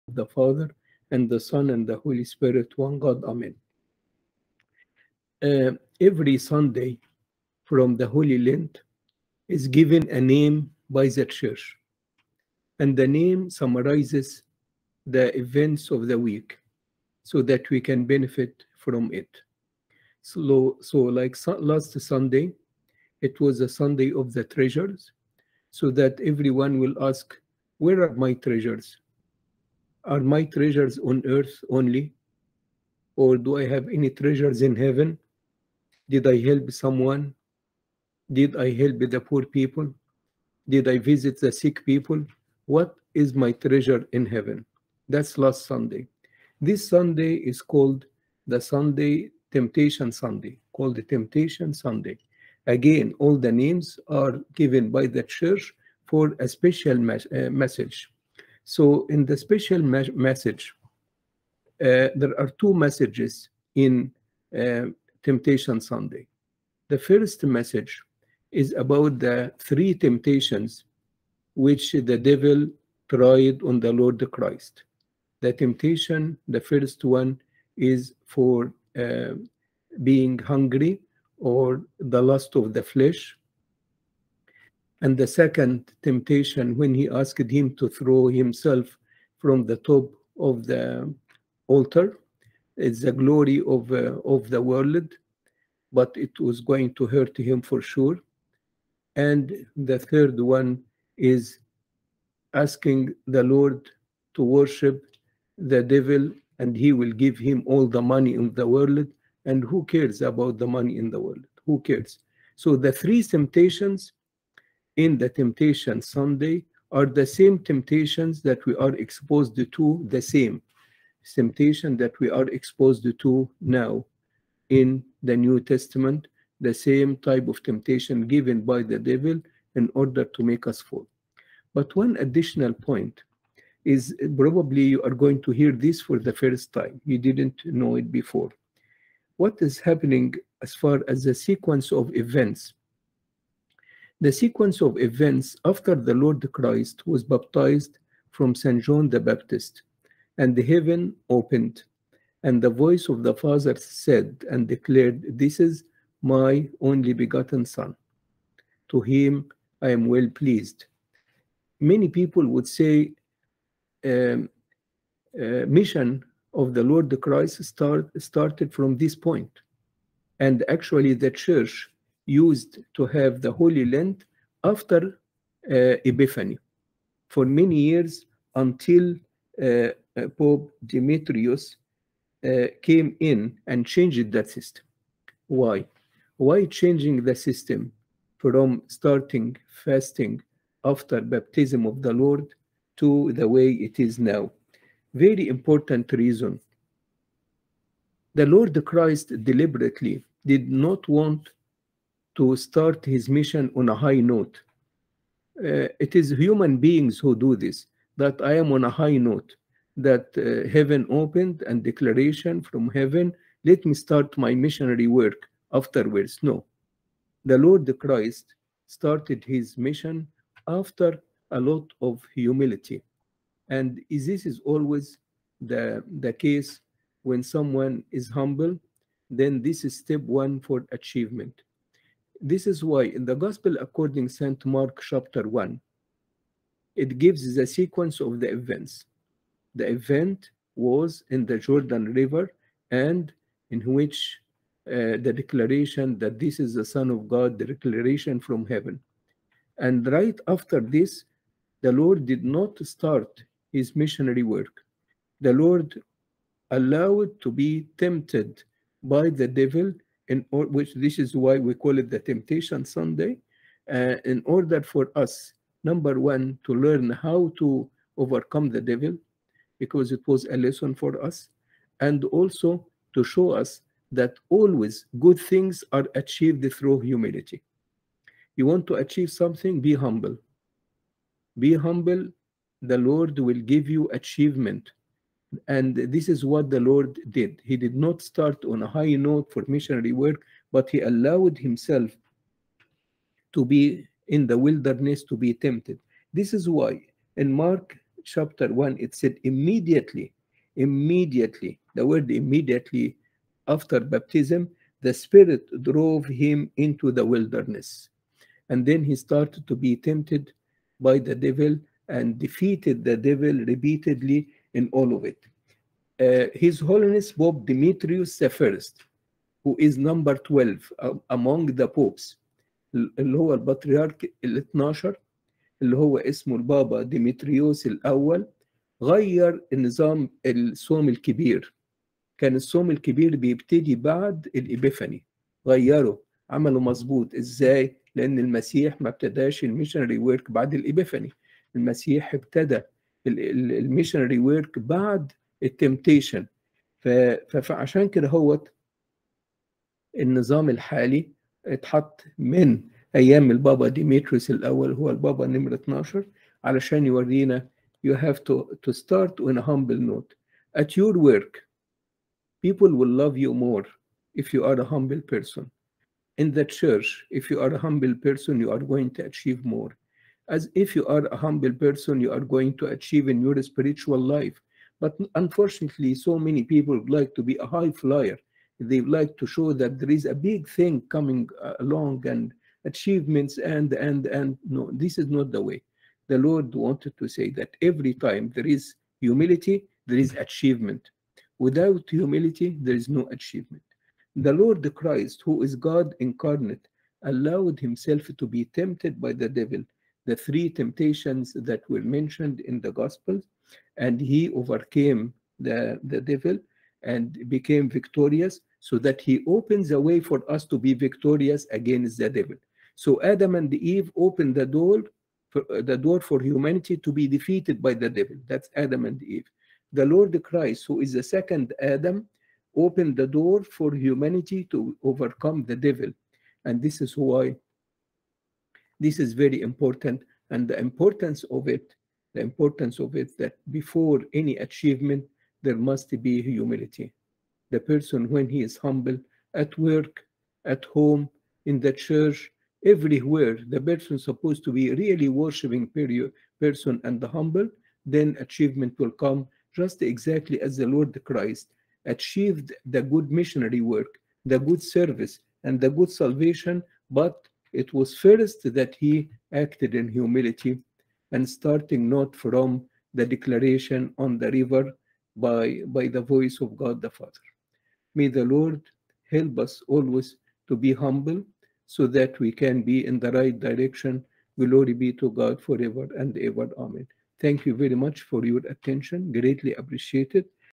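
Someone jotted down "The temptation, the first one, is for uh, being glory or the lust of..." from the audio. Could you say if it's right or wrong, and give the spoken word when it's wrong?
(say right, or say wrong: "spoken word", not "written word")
wrong: "hungry", not "glory".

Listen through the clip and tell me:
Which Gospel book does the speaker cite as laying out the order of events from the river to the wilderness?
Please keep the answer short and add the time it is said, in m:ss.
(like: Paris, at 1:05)
Mark chapter 1, at 3:54.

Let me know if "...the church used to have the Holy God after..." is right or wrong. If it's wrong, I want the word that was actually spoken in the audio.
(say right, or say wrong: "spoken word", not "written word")
wrong: "Lent", not "God".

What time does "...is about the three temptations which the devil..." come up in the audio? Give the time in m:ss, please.
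1:08.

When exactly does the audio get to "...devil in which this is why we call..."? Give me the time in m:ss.
4:19.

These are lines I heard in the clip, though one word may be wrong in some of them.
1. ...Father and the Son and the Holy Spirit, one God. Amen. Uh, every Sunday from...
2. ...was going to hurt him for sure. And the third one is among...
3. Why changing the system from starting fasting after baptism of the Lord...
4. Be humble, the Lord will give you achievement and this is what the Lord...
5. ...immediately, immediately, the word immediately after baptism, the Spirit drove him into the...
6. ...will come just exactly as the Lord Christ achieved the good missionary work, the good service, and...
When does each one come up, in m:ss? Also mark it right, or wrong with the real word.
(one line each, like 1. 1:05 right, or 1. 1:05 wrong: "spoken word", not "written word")
1. 0:00 right
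2. 1:36 wrong: "asking", not "among"
3. 3:06 right
4. 4:41 right
5. 4:59 right
6. 7:28 right.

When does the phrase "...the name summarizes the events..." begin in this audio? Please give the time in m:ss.
0:12.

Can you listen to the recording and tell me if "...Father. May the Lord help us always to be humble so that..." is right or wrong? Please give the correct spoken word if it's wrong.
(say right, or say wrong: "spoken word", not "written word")
right.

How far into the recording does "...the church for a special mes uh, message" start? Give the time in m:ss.
0:55.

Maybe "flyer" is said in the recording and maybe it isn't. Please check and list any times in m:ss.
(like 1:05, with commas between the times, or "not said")
6:17.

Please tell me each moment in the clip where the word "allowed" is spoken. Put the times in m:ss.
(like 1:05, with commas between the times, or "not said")
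4:16, 4:51, 6:37.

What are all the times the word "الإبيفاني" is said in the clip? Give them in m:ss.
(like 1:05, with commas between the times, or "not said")
5:34, 5:40.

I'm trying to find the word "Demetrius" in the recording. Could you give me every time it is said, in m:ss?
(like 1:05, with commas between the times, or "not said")
3:00, 5:17.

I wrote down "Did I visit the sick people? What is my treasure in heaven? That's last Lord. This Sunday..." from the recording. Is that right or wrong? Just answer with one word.
wrong.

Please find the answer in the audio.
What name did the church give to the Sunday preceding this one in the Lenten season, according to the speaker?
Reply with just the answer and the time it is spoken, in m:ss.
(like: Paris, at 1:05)
Sunday of the treasures, at 0:23.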